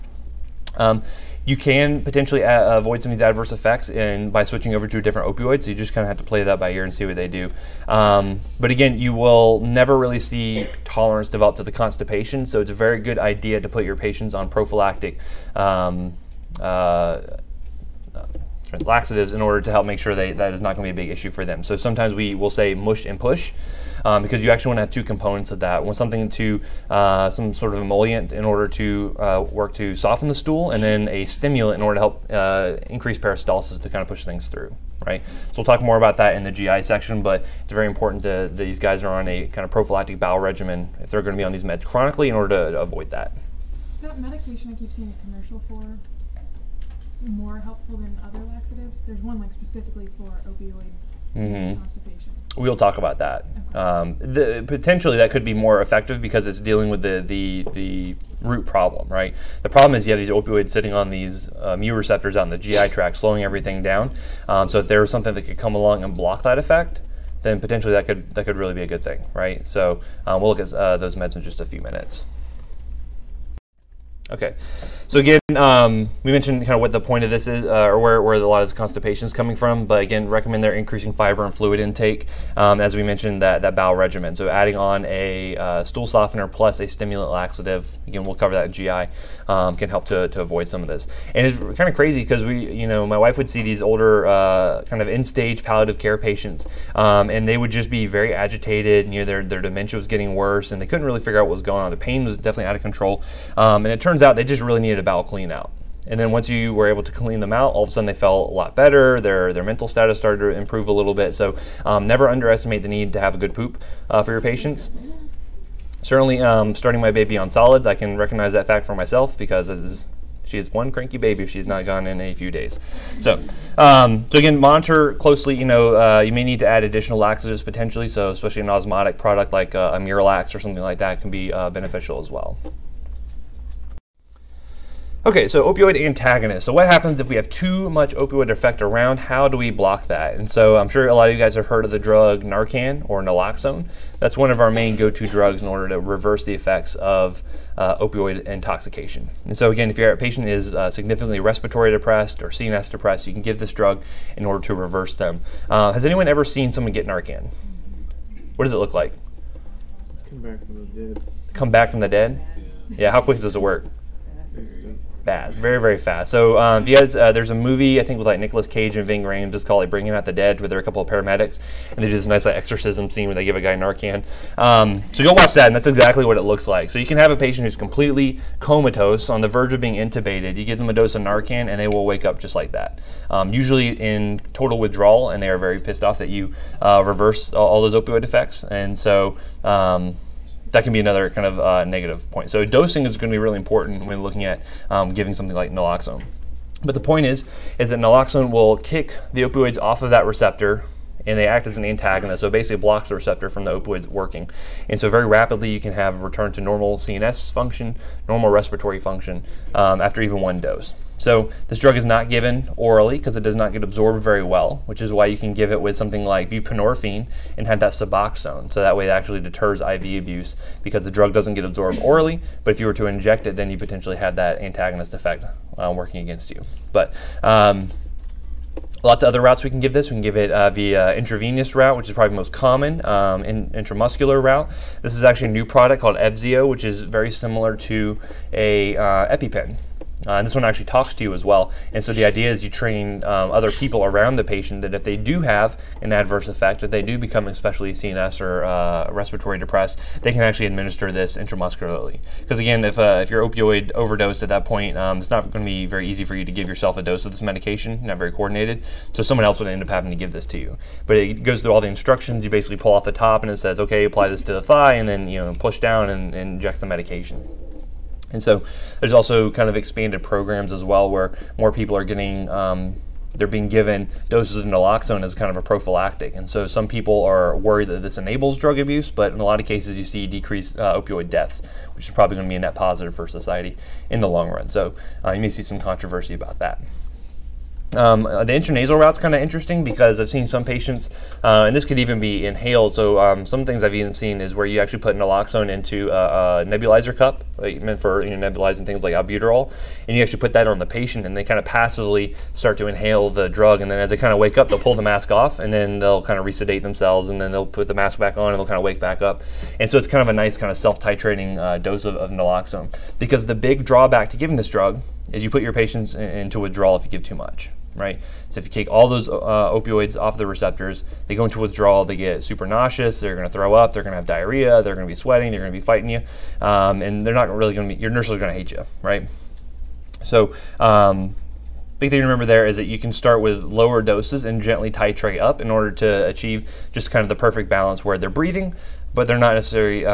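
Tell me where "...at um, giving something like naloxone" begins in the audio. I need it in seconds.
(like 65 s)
194 s.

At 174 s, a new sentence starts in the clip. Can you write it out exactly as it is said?
Um, so go watch that, and that's exactly what it looks like.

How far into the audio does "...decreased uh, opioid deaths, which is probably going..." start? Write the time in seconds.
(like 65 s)
280 s.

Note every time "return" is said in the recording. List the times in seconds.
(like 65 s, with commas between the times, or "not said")
206 s.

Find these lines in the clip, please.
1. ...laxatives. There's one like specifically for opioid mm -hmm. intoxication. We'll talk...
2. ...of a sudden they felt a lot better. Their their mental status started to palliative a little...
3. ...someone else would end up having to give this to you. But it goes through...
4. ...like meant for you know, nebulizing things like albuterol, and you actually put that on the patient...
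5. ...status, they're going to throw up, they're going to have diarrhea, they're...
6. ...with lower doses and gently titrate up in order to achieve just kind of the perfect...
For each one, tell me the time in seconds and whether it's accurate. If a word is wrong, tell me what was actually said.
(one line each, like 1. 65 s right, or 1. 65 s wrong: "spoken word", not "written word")
1. 48 s wrong: "constipation", not "intoxication"
2. 107 s wrong: "improve", not "palliative"
3. 259 s right
4. 297 s right
5. 322 s wrong: "nauseous", not "status"
6. 333 s right.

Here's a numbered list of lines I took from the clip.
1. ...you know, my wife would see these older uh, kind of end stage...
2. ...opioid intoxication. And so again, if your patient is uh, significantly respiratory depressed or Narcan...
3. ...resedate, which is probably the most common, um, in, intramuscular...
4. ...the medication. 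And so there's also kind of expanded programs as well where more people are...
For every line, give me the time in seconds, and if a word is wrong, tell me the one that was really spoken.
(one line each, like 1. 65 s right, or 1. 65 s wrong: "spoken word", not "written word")
1. 92 s right
2. 147 s wrong: "CNS", not "Narcan"
3. 231 s wrong: "route", not "resedate"
4. 266 s right.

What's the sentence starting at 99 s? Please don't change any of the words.
And, you know, their their dementia was getting worse, and they couldn't really figure out what was going on.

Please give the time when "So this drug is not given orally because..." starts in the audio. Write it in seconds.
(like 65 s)
211 s.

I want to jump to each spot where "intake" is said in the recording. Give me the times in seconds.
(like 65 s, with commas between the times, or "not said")
81 s.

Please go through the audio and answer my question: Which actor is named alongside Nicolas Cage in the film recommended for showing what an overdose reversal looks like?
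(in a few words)
Ving Rhames.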